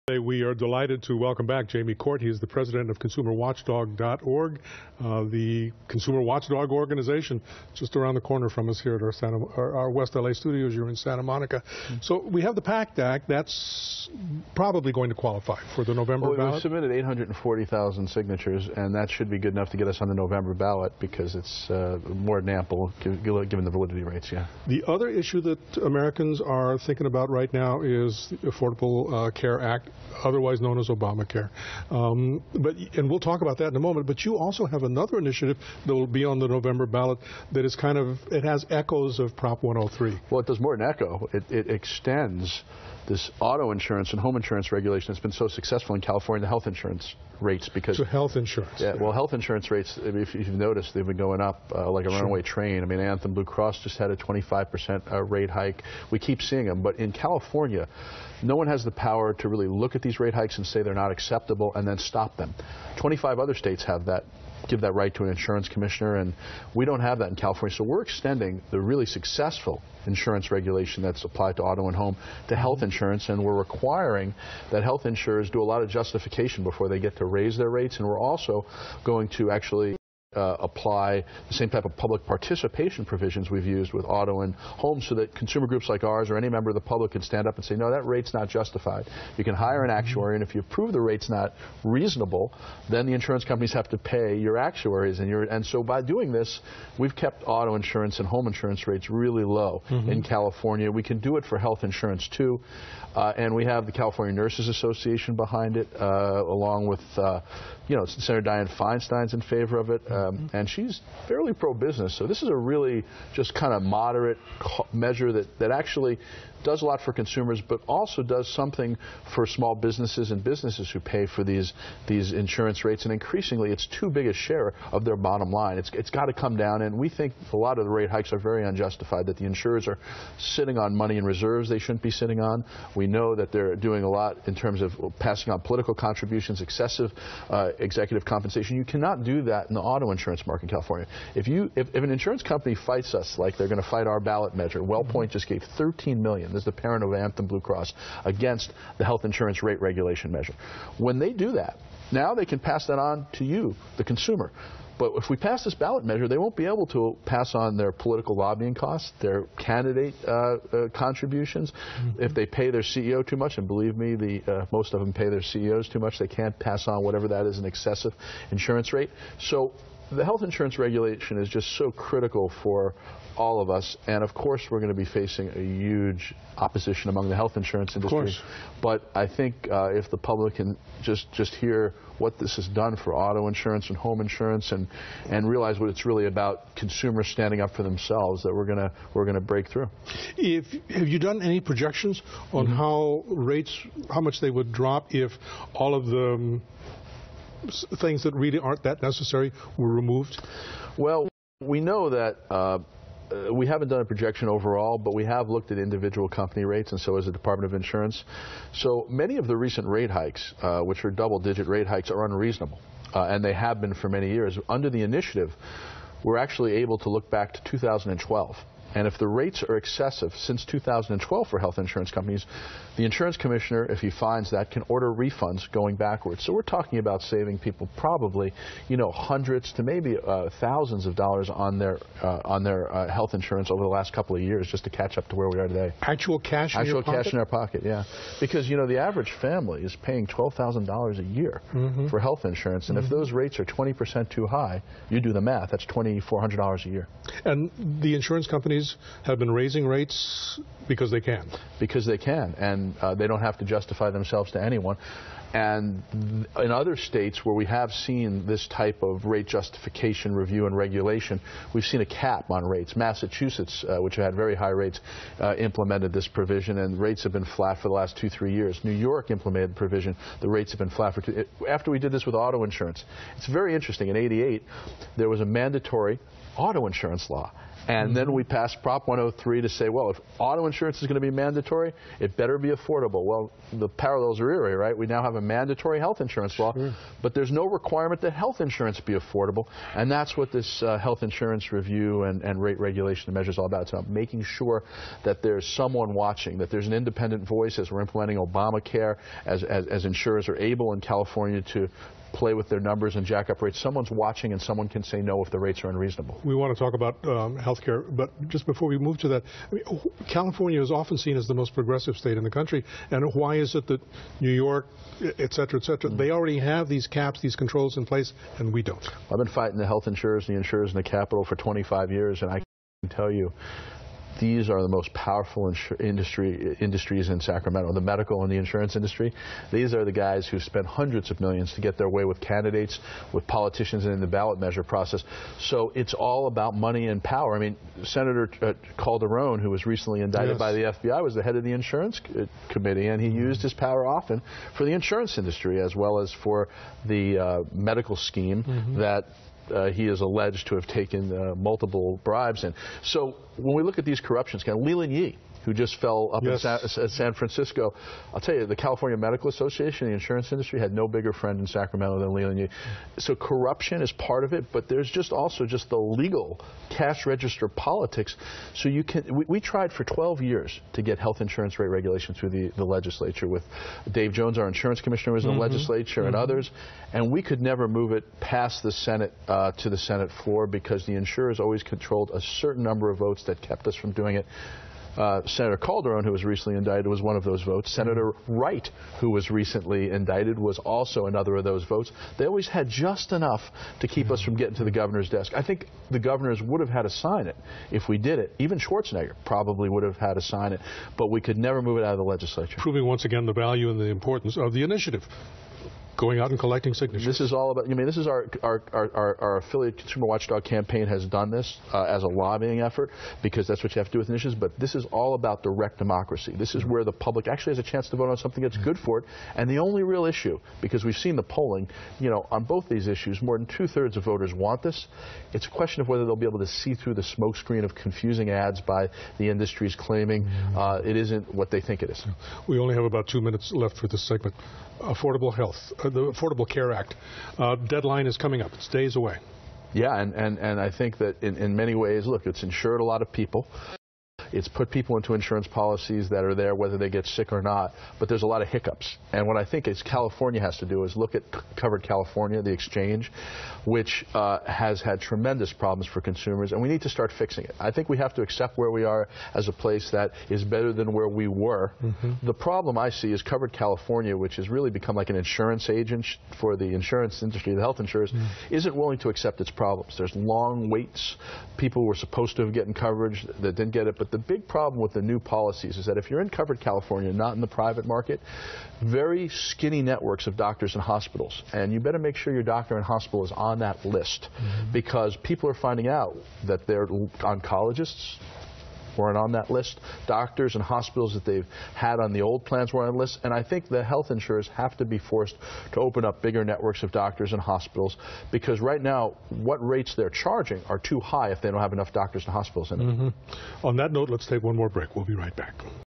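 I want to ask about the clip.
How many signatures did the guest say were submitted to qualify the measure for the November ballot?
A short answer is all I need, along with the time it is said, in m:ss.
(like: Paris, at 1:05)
840,000, at 0:16.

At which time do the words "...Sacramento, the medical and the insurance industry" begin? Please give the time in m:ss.
5:27.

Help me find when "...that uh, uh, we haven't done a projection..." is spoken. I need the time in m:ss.
3:22.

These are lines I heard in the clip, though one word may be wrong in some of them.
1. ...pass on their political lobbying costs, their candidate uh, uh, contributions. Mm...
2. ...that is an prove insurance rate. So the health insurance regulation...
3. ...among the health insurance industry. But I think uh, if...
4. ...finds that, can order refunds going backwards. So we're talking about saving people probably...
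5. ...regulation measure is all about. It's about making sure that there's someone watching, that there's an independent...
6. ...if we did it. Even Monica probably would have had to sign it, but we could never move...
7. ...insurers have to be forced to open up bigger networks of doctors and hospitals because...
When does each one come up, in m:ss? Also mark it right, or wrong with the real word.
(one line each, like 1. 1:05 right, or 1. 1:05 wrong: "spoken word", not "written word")
1. 2:37 right
2. 2:47 wrong: "excessive", not "prove"
3. 2:57 right
4. 3:44 right
5. 4:52 right
6. 6:37 wrong: "Schwarzenegger", not "Monica"
7. 8:14 right.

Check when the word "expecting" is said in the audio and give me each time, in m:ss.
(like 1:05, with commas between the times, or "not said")
not said.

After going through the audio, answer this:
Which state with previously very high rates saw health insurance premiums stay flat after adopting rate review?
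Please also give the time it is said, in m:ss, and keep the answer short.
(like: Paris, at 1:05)
Massachusetts, at 4:22.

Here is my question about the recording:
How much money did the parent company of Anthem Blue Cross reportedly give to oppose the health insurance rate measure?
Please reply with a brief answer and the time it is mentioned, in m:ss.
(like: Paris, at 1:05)
13 million, at 2:25.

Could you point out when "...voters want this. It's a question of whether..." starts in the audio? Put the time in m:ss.
7:04.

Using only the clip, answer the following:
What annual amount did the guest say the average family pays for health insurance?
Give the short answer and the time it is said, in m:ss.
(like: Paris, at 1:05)
$12,000, at 4:00.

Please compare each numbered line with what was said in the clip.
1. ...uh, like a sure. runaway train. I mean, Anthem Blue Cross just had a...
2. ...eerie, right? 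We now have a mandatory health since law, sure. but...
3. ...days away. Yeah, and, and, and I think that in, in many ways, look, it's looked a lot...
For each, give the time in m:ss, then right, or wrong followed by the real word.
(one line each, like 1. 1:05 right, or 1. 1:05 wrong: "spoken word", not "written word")
1. 0:51 right
2. 4:44 wrong: "insurance", not "since"
3. 7:18 wrong: "insured", not "looked".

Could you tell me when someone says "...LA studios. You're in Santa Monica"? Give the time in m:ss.
0:10.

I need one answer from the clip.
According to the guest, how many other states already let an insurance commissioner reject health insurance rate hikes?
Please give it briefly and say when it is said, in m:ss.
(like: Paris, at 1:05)
25, at 1:02.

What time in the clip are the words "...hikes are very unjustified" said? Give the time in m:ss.
2:08.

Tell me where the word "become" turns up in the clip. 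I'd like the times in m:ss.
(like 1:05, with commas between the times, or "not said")
7:44.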